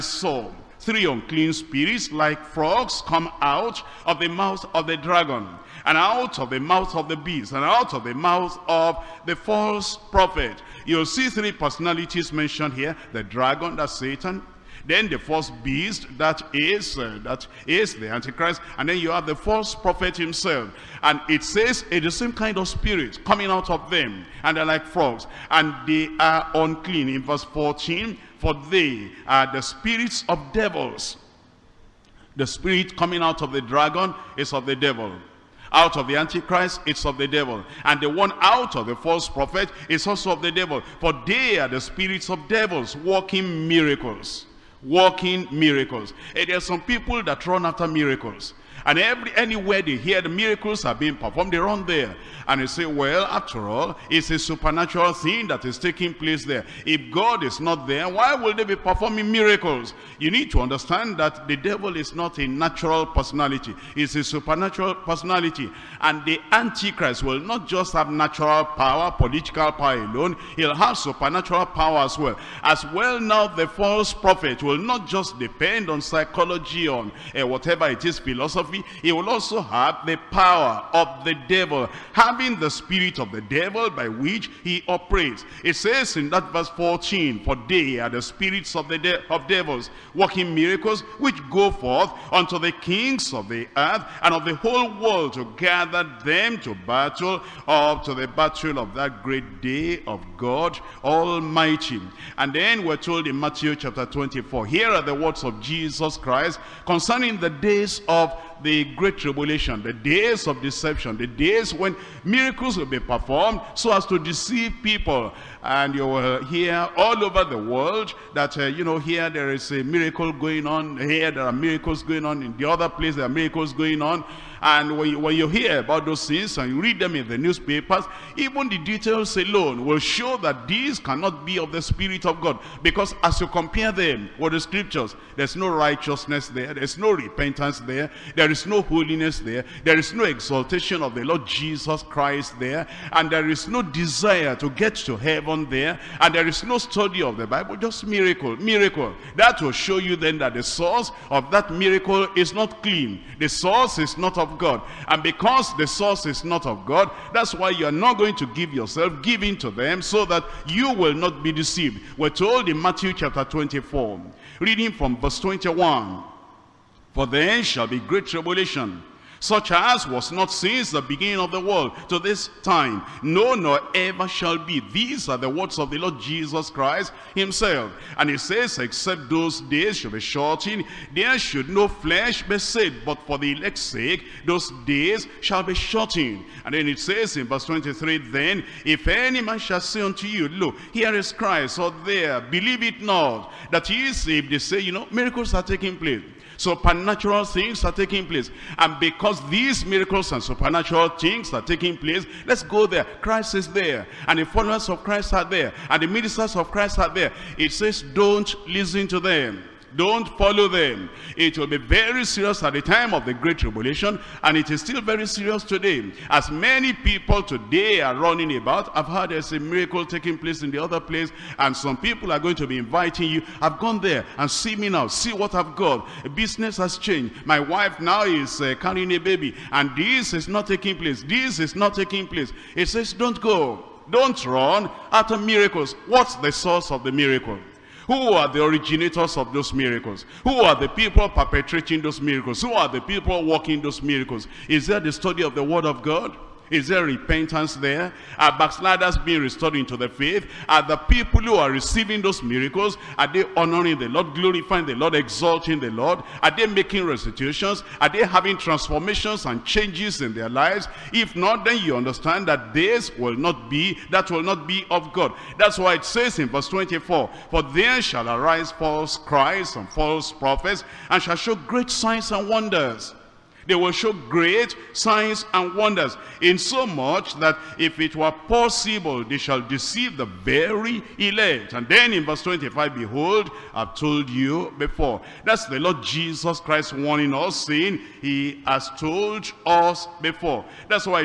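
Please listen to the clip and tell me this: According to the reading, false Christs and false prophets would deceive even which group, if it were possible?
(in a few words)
The very elect.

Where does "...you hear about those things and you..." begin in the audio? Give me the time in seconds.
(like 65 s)
125 s.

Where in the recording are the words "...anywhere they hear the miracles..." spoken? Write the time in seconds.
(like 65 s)
49 s.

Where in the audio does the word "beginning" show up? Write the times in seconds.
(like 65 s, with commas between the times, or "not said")
171 s.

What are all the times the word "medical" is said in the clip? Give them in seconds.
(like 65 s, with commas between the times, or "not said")
not said.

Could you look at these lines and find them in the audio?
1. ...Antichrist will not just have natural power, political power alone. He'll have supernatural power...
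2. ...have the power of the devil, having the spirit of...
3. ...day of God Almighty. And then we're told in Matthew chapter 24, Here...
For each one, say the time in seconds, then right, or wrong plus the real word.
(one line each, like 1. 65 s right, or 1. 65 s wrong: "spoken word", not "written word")
1. 66 s right
2. 79 s right
3. 99 s right.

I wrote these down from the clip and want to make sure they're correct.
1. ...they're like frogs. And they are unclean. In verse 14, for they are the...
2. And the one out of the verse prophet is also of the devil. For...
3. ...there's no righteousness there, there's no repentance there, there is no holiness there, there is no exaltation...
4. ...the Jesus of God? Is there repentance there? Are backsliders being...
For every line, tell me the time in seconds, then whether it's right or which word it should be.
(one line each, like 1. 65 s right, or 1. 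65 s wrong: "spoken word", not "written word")
1. 24 s right
2. 37 s wrong: "false", not "verse"
3. 135 s right
4. 245 s wrong: "Word", not "Jesus".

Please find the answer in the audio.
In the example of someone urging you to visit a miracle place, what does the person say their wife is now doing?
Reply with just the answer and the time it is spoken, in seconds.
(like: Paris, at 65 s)
Carrying a baby, at 228 s.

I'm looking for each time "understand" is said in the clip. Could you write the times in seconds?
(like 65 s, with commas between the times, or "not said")
60 s, 261 s.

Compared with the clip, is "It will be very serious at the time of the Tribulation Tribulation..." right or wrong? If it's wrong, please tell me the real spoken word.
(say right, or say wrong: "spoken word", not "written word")
wrong: "Great", not "Tribulation".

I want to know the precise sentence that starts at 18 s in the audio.
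And then you have the false prophet himself.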